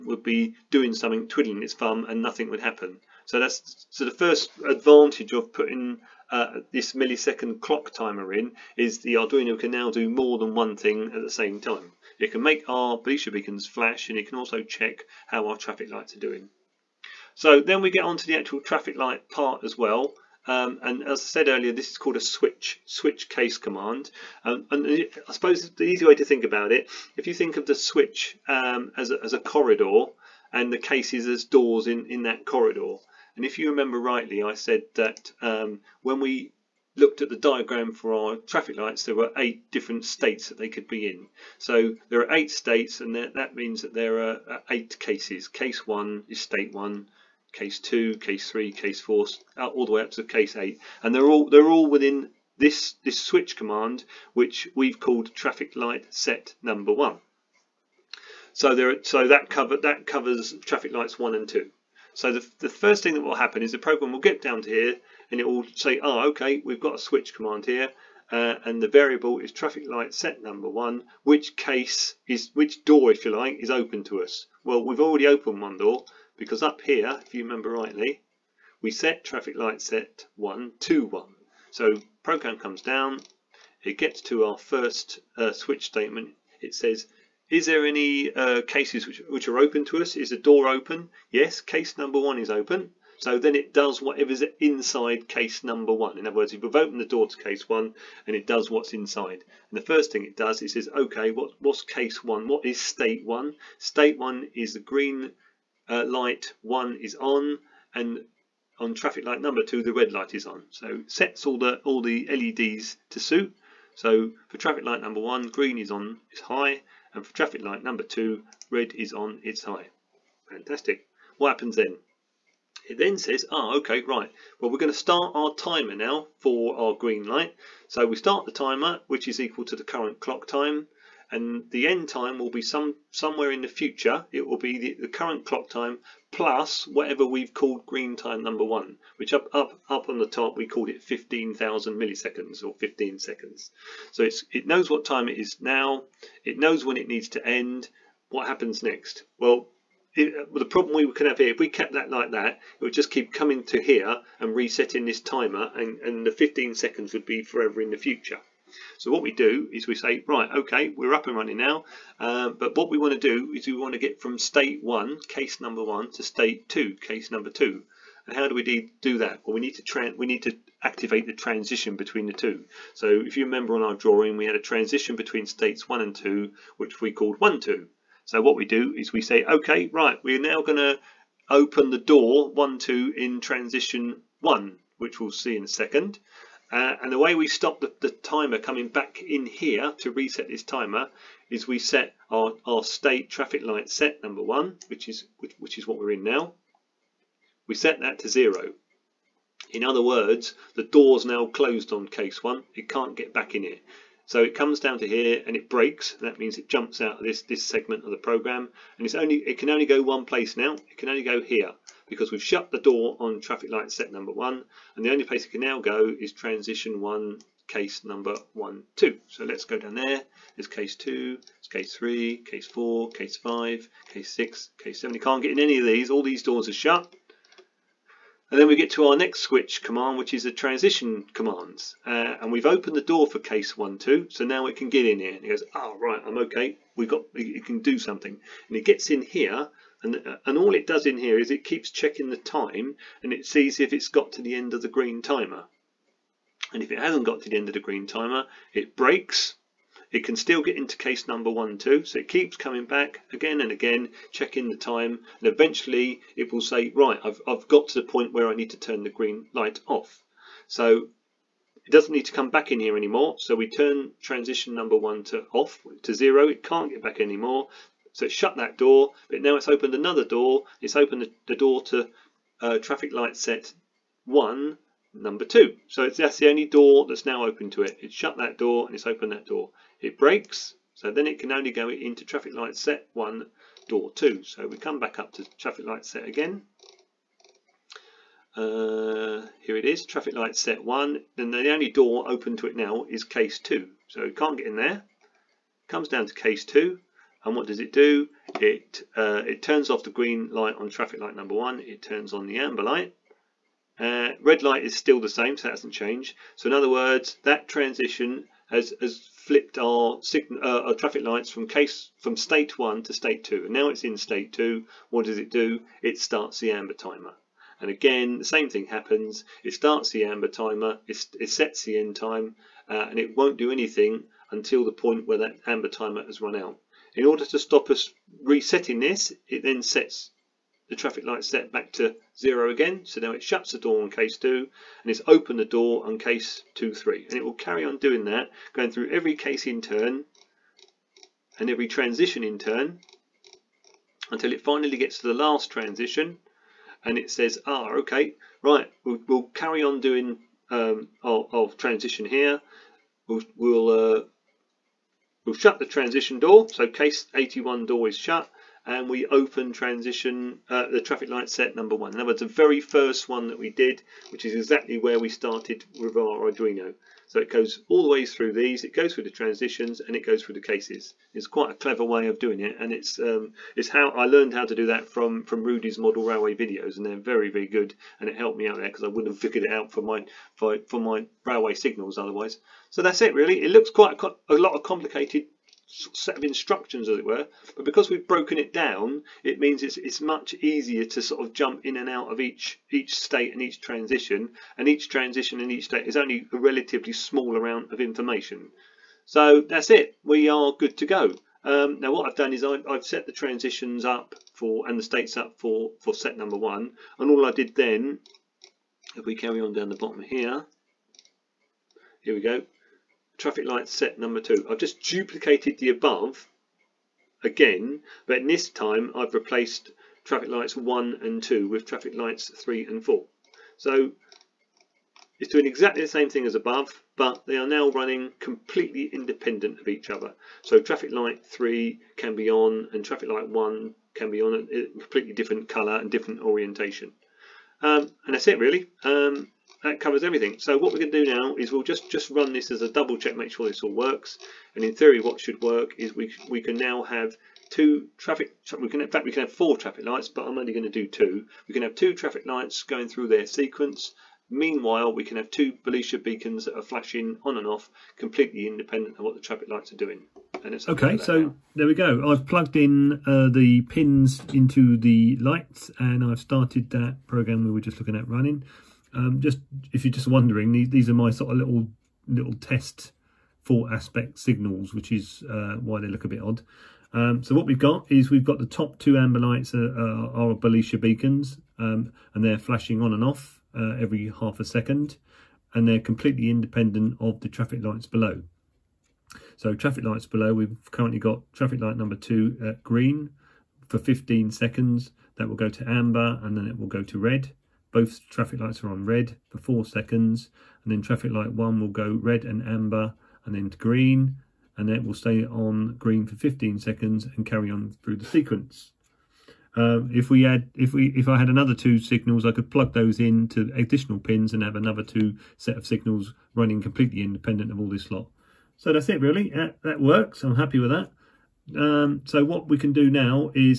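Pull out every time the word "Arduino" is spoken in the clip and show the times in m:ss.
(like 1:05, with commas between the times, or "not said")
0:09, 6:06.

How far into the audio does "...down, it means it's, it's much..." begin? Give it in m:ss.
6:28.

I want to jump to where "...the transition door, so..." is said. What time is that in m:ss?
5:55.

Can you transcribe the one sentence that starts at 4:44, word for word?
So we come back up to traffic light set again.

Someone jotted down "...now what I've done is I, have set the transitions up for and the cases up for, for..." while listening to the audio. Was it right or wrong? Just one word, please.
wrong.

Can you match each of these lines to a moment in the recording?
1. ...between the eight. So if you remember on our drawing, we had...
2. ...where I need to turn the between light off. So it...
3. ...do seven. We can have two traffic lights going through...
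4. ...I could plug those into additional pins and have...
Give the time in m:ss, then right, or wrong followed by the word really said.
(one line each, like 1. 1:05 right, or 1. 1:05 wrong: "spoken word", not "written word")
1. 2:51 wrong: "two", not "eight"
2. 4:18 wrong: "green", not "between"
3. 7:30 wrong: "two", not "seven"
4. 8:32 right.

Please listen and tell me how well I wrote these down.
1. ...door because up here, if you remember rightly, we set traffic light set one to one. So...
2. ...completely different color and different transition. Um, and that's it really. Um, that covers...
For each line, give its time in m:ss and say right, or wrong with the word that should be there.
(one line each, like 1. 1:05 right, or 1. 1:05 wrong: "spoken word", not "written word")
1. 1:15 right
2. 7:14 wrong: "orientation", not "transition".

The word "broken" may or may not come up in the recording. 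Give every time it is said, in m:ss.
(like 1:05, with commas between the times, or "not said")
6:28.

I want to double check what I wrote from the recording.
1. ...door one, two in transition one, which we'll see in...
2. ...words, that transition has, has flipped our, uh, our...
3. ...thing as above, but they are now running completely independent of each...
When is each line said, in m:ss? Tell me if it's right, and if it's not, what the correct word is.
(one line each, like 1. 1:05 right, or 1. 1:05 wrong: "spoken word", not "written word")
1. 3:02 right
2. 5:06 right
3. 7:06 right.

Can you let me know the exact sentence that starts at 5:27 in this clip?
In order to stop us resetting this, it then sets the traffic light set back to zero again.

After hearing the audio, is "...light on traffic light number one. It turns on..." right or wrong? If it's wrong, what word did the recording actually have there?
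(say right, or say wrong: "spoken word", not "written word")
right.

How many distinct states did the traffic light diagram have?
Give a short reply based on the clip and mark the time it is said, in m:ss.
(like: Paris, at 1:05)
8, at 0:39.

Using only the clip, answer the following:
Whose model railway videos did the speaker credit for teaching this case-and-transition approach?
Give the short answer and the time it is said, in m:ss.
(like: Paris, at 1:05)
Rudy, at 6:15.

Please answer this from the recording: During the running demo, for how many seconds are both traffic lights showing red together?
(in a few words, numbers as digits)
4 seconds.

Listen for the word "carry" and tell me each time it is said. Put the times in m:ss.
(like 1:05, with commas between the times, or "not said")
5:37, 5:49, 6:49, 8:27.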